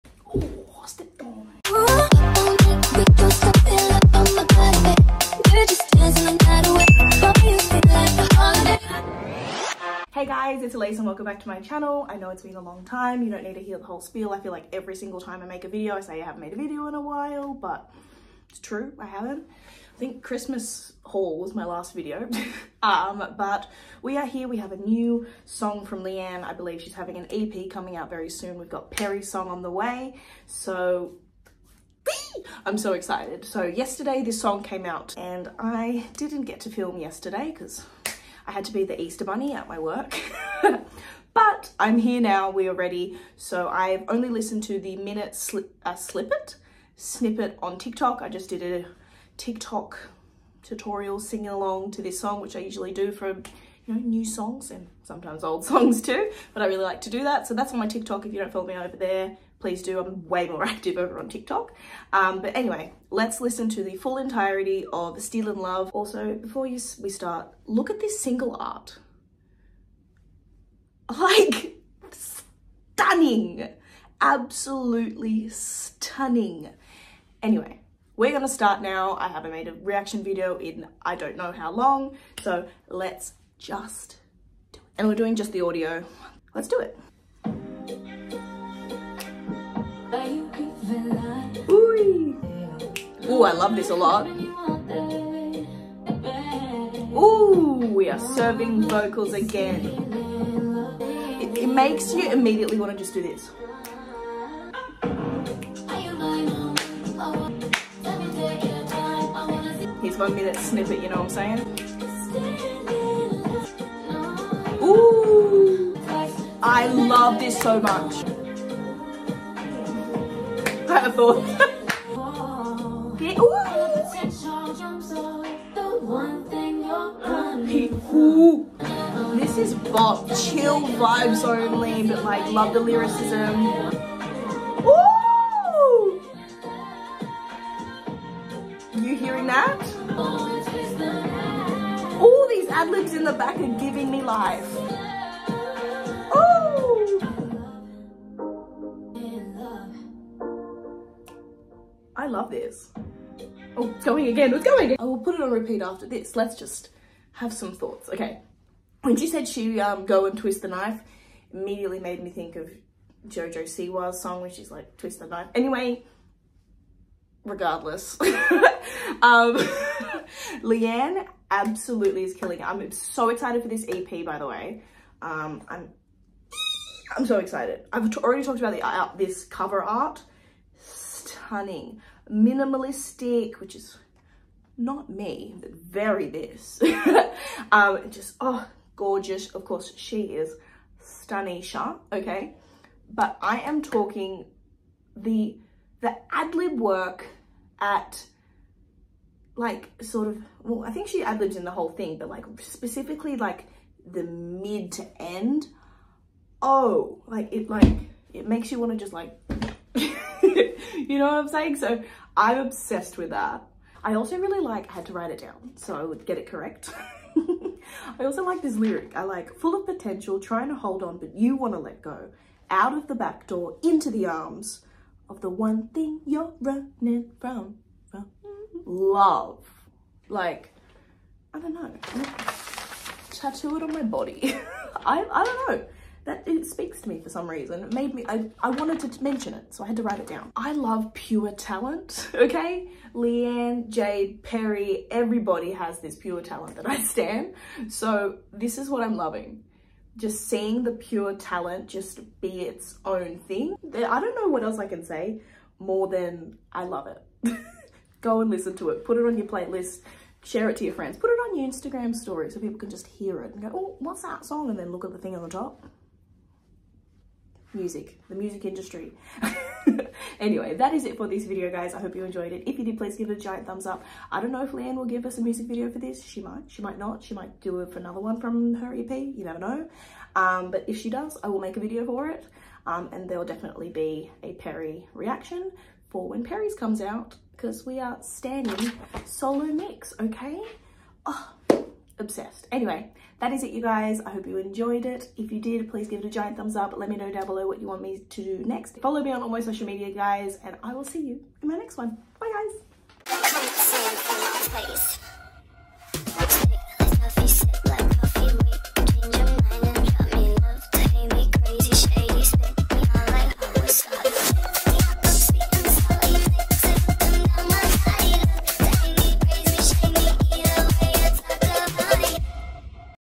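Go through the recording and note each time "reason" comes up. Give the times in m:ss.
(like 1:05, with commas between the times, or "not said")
3:57.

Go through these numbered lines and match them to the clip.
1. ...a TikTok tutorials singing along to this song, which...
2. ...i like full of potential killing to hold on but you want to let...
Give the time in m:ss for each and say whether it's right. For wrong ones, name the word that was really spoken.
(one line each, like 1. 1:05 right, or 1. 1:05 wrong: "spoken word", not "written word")
1. 0:48 right
2. 3:39 wrong: "trying", not "killing".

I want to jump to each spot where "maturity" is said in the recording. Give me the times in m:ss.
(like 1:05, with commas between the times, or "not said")
not said.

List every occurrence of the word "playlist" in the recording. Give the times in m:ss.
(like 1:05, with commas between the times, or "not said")
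4:19.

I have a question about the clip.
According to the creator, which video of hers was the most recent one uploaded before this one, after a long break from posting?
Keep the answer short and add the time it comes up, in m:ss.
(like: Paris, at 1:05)
Christmas haul, at 0:20.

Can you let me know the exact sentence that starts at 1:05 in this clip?
Also, before you, we start, look at this single art.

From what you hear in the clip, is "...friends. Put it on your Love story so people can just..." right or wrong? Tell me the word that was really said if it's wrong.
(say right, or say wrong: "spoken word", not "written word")
wrong: "Instagram", not "Love".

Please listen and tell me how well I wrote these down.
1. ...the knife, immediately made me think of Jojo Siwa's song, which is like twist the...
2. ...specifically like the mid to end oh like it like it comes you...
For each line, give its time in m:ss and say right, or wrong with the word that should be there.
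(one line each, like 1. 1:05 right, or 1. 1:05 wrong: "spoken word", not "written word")
1. 2:40 right
2. 3:22 wrong: "makes", not "comes".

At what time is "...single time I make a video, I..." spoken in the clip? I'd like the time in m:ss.
0:14.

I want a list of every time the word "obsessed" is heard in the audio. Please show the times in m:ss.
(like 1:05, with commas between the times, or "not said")
3:32, 4:52.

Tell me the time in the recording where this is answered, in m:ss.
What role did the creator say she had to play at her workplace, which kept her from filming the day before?
0:38.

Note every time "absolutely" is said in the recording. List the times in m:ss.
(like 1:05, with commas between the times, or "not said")
1:14, 2:51.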